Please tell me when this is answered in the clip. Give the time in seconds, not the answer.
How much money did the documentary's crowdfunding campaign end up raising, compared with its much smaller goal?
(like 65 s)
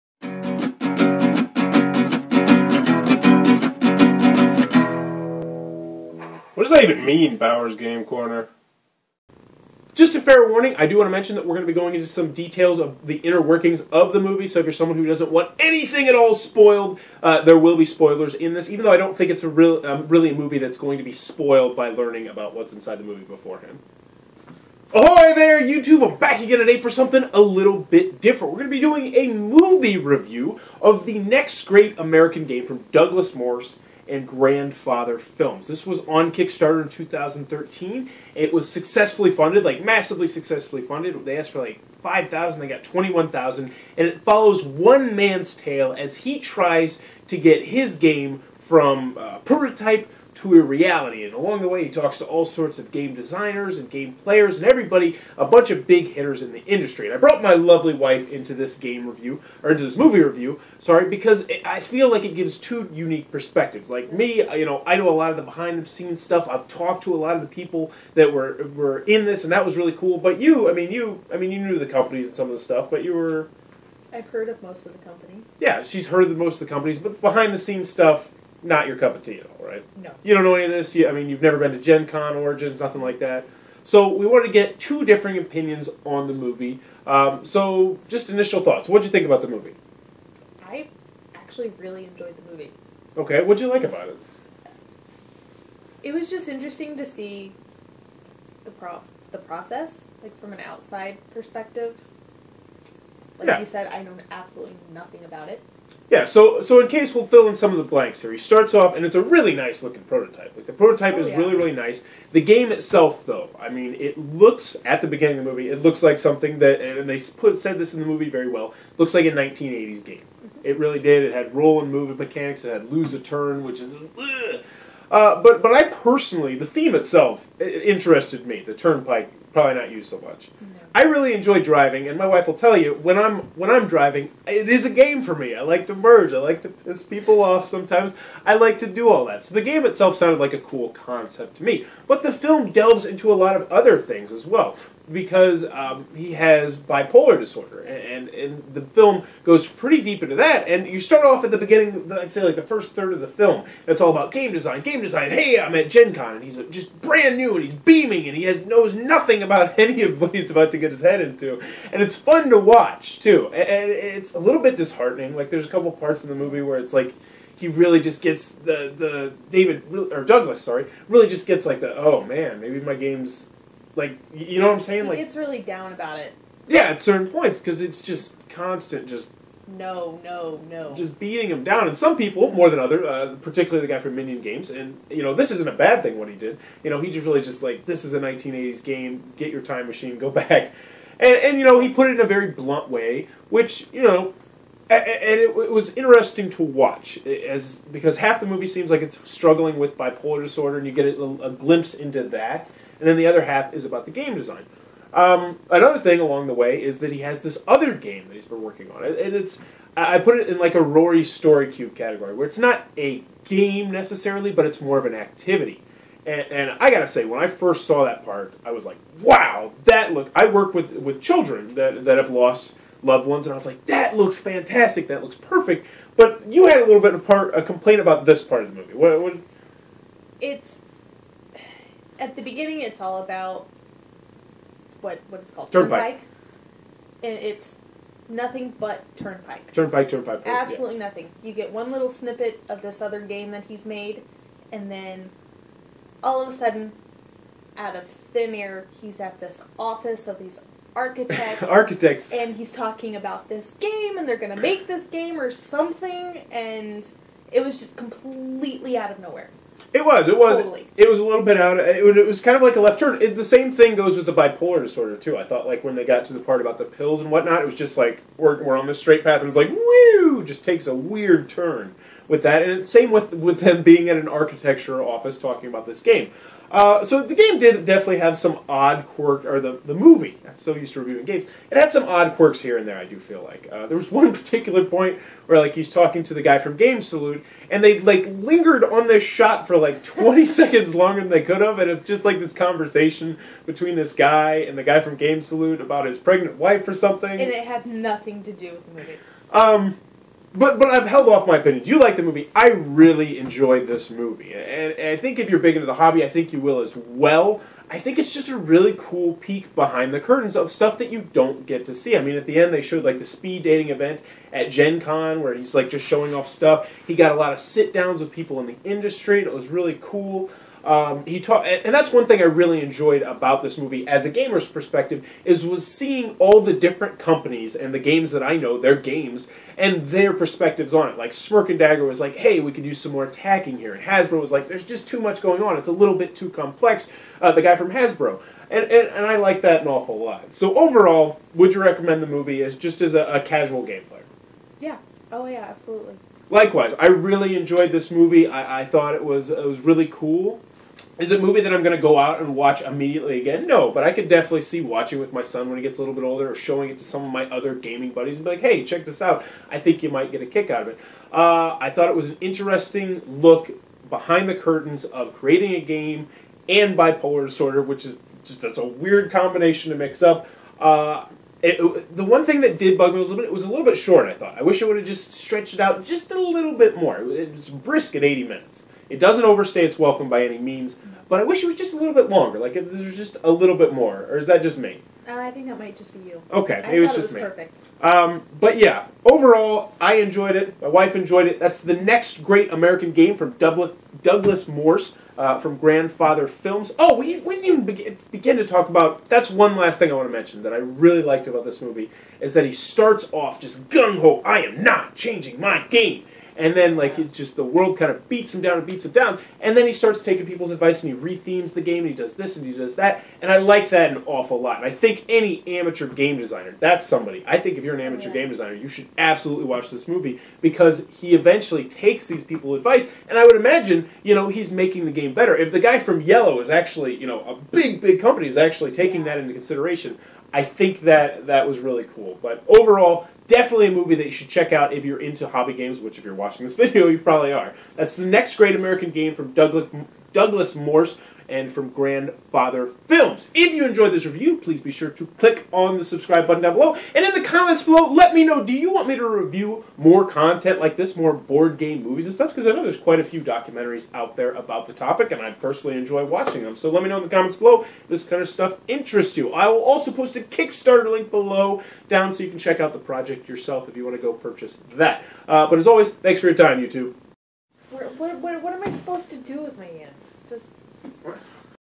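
42 s.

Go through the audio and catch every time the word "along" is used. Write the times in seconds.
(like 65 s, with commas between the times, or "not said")
51 s, 206 s.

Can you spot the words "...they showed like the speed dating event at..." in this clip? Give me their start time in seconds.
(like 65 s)
312 s.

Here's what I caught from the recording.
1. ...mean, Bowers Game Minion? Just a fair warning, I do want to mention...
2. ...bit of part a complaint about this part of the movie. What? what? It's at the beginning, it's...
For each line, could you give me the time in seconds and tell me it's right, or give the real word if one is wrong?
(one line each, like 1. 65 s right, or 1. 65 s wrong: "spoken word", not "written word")
1. 7 s wrong: "Corner", not "Minion"
2. 227 s right.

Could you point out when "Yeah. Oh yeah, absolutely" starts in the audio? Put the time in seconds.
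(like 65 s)
344 s.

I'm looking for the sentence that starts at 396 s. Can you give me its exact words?
Oh, we, we didn't even begin to talk about.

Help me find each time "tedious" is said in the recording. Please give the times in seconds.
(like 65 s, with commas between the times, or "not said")
not said.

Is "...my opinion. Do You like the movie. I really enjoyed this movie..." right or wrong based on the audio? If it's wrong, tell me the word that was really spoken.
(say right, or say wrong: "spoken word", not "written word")
right.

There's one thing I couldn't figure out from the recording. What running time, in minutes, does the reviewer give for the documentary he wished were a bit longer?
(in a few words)
80.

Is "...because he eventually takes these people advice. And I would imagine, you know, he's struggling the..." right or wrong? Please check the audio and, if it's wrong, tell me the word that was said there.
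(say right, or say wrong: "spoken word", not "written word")
wrong: "making", not "struggling".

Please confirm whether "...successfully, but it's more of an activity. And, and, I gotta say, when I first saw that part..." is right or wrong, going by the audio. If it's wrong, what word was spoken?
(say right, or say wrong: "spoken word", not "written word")
wrong: "necessarily", not "successfully".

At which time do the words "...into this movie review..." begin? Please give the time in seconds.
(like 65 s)
59 s.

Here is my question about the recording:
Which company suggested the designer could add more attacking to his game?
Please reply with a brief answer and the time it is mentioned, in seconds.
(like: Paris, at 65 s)
Smirk and Dagger, at 331 s.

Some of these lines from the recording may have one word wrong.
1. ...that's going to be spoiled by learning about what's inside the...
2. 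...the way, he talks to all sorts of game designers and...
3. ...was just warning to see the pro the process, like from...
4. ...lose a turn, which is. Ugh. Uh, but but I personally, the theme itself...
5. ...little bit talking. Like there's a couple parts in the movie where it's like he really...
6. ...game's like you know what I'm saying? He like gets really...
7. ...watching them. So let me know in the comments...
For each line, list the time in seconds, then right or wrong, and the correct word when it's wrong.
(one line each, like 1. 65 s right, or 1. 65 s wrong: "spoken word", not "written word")
1. 20 s right
2. 51 s right
3. 96 s wrong: "interesting", not "warning"
4. 122 s right
5. 164 s wrong: "disheartening", not "talking"
6. 172 s right
7. 456 s right.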